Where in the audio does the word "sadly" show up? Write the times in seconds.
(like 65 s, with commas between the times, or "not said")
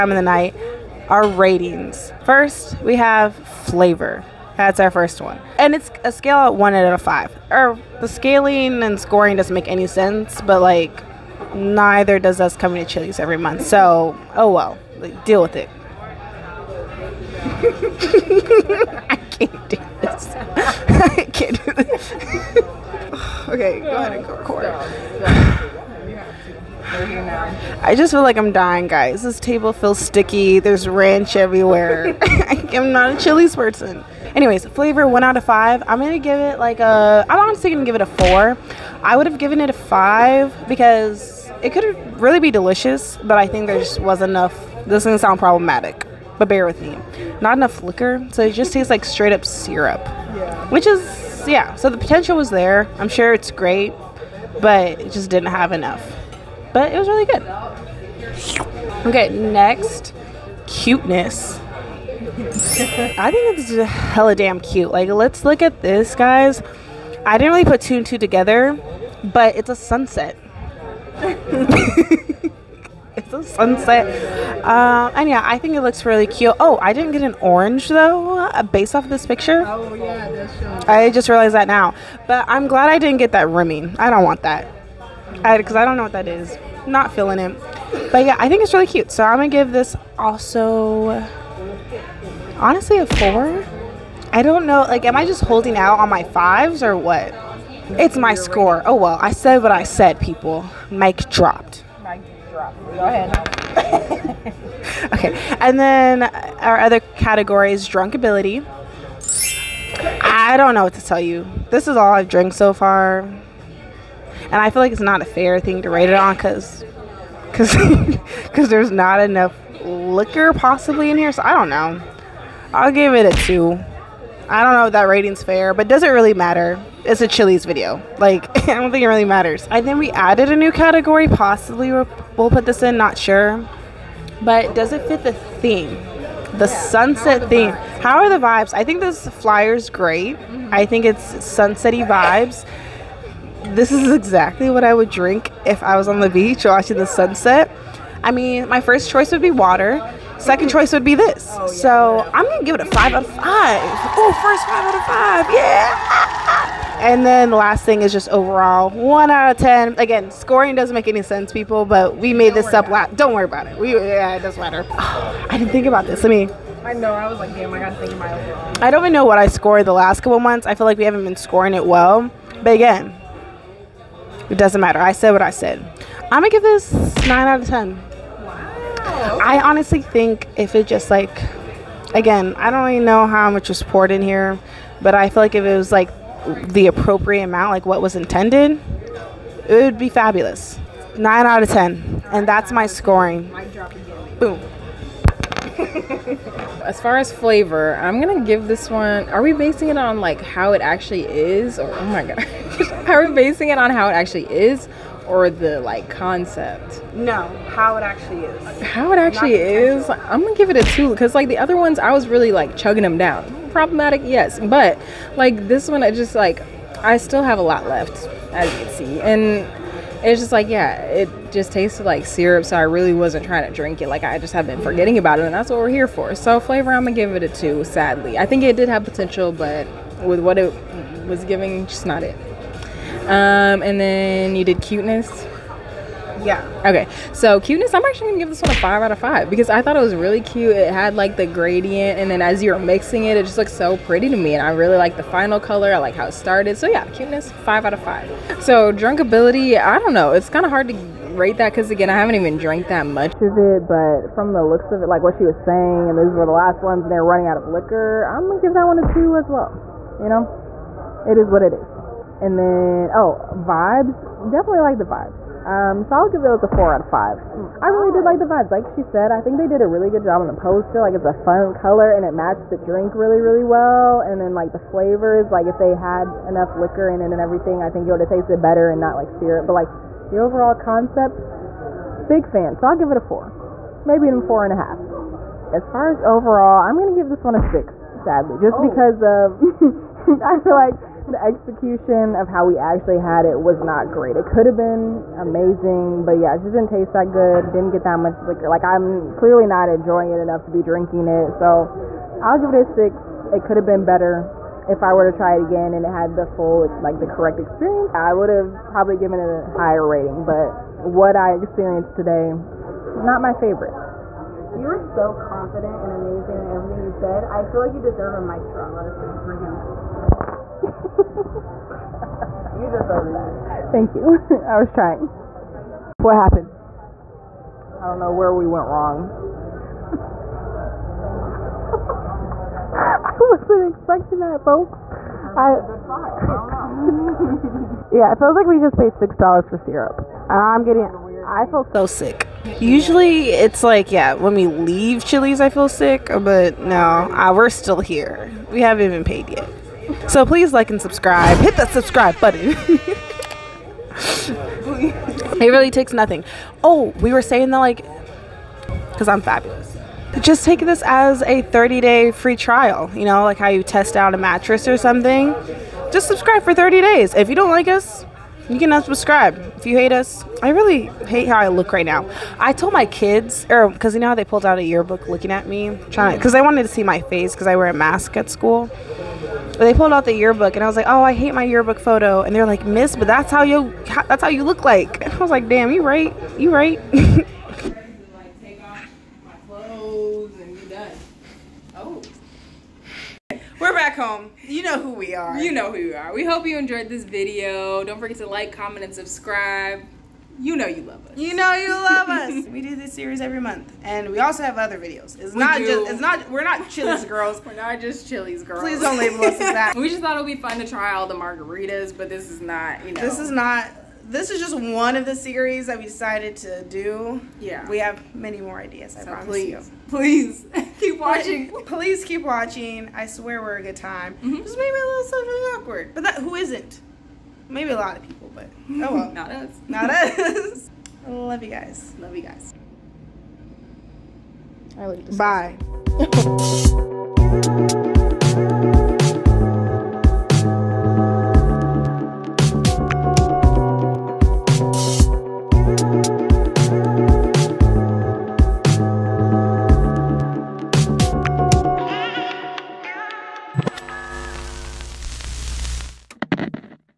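227 s, 288 s.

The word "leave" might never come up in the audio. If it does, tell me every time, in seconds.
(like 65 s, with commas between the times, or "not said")
344 s.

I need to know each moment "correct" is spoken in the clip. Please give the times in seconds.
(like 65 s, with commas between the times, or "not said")
307 s.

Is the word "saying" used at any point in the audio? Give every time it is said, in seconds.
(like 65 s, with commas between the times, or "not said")
255 s, 357 s.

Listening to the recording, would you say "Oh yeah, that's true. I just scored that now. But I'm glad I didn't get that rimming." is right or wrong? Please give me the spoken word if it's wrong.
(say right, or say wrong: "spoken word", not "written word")
wrong: "realized", not "scored".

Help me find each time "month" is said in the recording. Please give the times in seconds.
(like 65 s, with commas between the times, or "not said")
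13 s, 170 s, 403 s.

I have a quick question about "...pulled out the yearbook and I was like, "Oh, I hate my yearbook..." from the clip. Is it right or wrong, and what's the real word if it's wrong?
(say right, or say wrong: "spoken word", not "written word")
right.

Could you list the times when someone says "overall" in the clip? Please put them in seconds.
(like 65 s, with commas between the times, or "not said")
158 s, 168 s, 280 s, 286 s.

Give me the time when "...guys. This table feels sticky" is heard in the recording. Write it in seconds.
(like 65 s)
28 s.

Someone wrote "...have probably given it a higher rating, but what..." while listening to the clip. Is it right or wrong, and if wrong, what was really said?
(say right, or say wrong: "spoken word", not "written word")
right.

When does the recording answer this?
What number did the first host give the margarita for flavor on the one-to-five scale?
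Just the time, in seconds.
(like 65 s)
37 s.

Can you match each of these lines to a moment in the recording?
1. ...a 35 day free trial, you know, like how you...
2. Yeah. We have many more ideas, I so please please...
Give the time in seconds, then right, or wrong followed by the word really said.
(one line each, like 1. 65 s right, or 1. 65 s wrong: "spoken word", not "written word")
1. 361 s wrong: "30", not "35"
2. 417 s wrong: "promise", not "please".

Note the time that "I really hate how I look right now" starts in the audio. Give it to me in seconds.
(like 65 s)
370 s.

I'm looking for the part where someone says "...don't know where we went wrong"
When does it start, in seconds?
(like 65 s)
328 s.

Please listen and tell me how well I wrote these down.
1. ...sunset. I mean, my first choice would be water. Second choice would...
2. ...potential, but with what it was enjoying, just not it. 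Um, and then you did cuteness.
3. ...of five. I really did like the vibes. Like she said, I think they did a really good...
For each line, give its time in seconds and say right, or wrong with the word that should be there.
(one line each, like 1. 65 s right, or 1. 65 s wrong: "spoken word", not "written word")
1. 147 s right
2. 229 s wrong: "giving", not "enjoying"
3. 266 s right.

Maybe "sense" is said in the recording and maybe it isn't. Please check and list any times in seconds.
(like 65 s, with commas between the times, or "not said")
9 s, 161 s.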